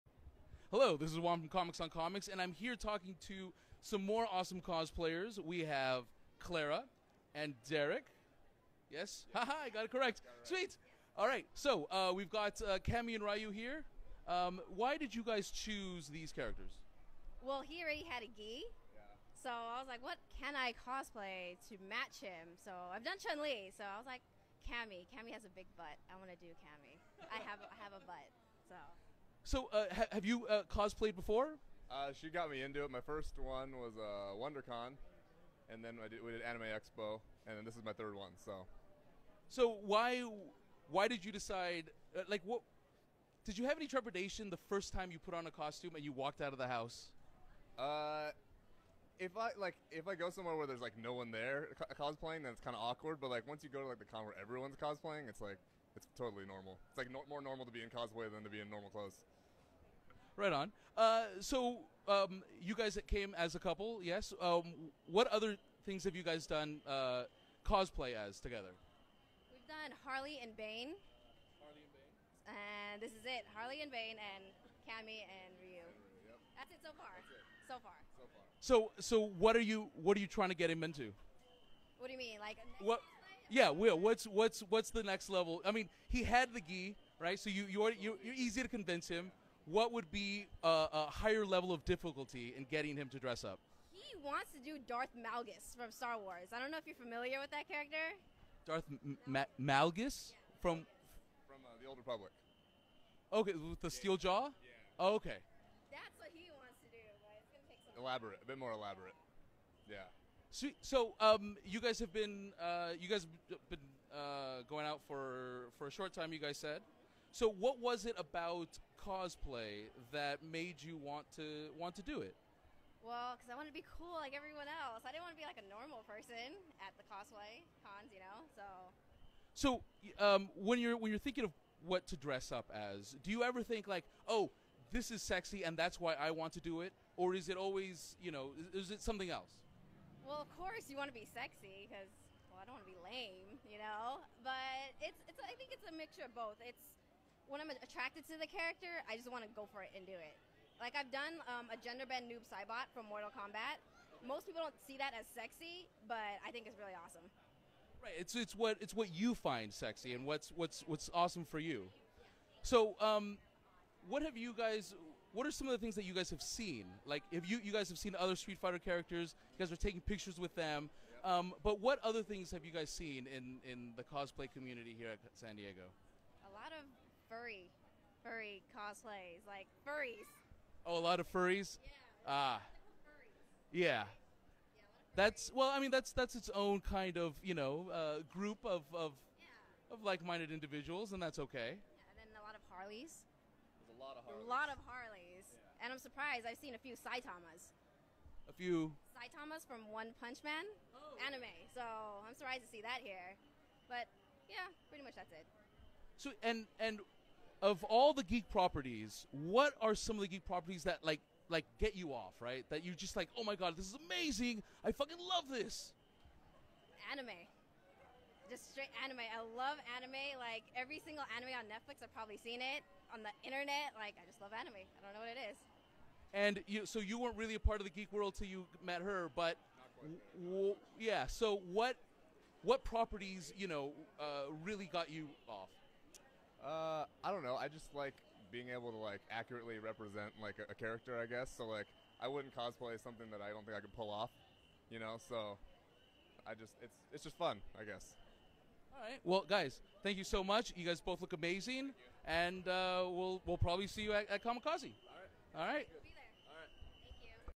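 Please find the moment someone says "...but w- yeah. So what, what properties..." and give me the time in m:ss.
3:49.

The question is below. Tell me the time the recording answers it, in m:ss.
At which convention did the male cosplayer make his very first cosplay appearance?
0:34.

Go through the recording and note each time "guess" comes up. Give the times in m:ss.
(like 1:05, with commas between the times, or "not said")
4:01, 4:07.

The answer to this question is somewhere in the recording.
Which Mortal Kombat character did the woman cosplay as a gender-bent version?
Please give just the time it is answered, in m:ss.
2:32.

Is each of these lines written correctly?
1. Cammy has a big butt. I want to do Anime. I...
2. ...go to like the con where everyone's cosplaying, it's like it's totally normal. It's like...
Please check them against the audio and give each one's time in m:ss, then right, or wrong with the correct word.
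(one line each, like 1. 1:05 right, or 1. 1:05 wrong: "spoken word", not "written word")
1. 0:25 wrong: "Cammy", not "Anime"
2. 0:53 right.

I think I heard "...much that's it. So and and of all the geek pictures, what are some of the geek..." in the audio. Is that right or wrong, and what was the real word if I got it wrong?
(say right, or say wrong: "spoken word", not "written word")
wrong: "properties", not "pictures".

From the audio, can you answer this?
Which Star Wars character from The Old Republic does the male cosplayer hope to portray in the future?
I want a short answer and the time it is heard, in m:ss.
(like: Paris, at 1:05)
Darth Malgus, at 1:34.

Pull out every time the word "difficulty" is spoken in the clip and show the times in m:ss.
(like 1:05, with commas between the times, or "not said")
1:31.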